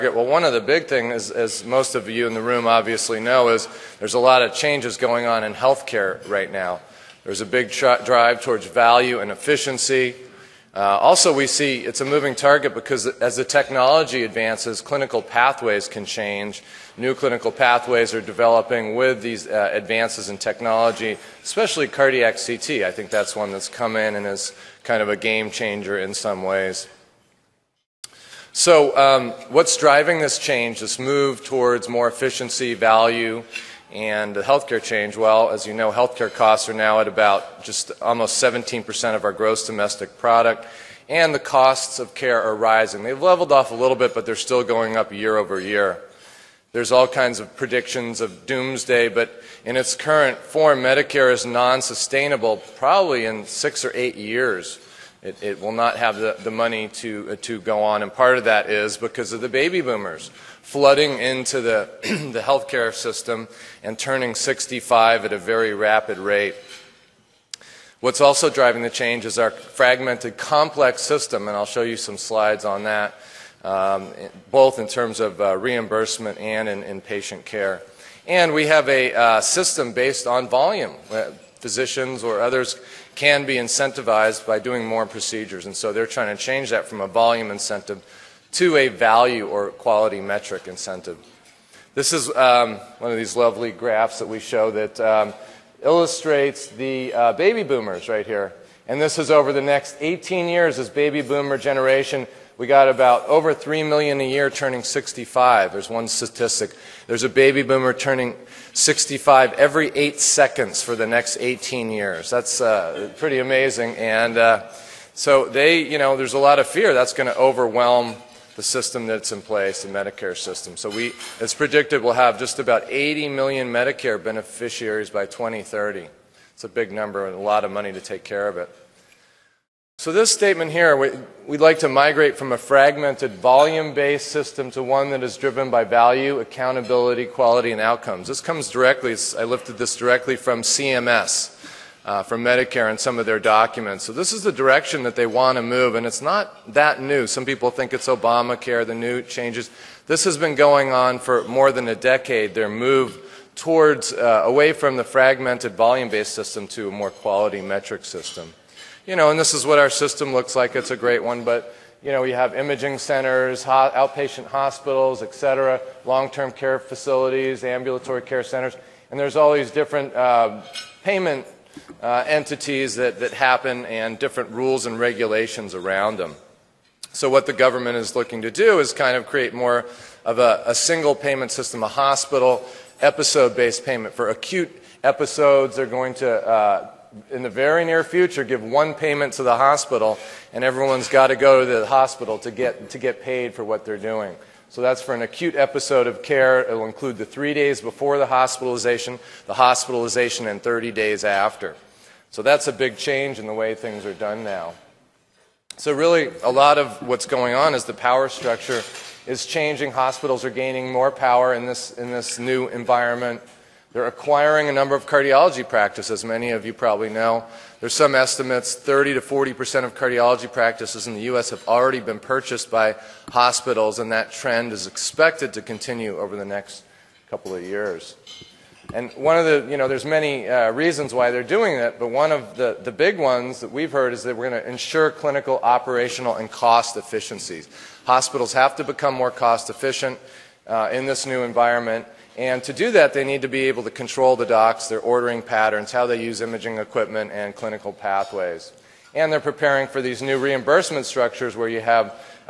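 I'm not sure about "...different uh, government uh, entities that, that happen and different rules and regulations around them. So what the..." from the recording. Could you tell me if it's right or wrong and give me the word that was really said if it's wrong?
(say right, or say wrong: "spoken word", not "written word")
wrong: "payment", not "government".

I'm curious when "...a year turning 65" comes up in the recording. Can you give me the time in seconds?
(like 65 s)
104 s.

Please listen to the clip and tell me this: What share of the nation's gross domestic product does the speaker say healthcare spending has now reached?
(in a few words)
almost 17%.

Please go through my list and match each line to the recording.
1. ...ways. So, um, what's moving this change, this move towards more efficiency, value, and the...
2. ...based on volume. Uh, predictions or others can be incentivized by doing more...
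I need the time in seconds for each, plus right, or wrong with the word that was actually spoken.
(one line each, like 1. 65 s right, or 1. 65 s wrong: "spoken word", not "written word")
1. 26 s wrong: "driving", not "moving"
2. 79 s wrong: "physicians", not "predictions".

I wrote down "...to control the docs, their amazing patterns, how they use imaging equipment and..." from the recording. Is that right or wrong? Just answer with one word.
wrong.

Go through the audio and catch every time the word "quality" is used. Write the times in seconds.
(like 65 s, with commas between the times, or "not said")
89 s, 137 s, 157 s.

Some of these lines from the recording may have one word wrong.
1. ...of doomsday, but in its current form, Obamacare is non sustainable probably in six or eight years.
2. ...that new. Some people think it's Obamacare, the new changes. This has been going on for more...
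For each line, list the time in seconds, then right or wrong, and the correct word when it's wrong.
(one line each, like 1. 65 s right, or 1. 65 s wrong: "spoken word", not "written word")
1. 48 s wrong: "Medicare", not "Obamacare"
2. 146 s right.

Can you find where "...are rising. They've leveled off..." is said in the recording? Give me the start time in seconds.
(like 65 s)
42 s.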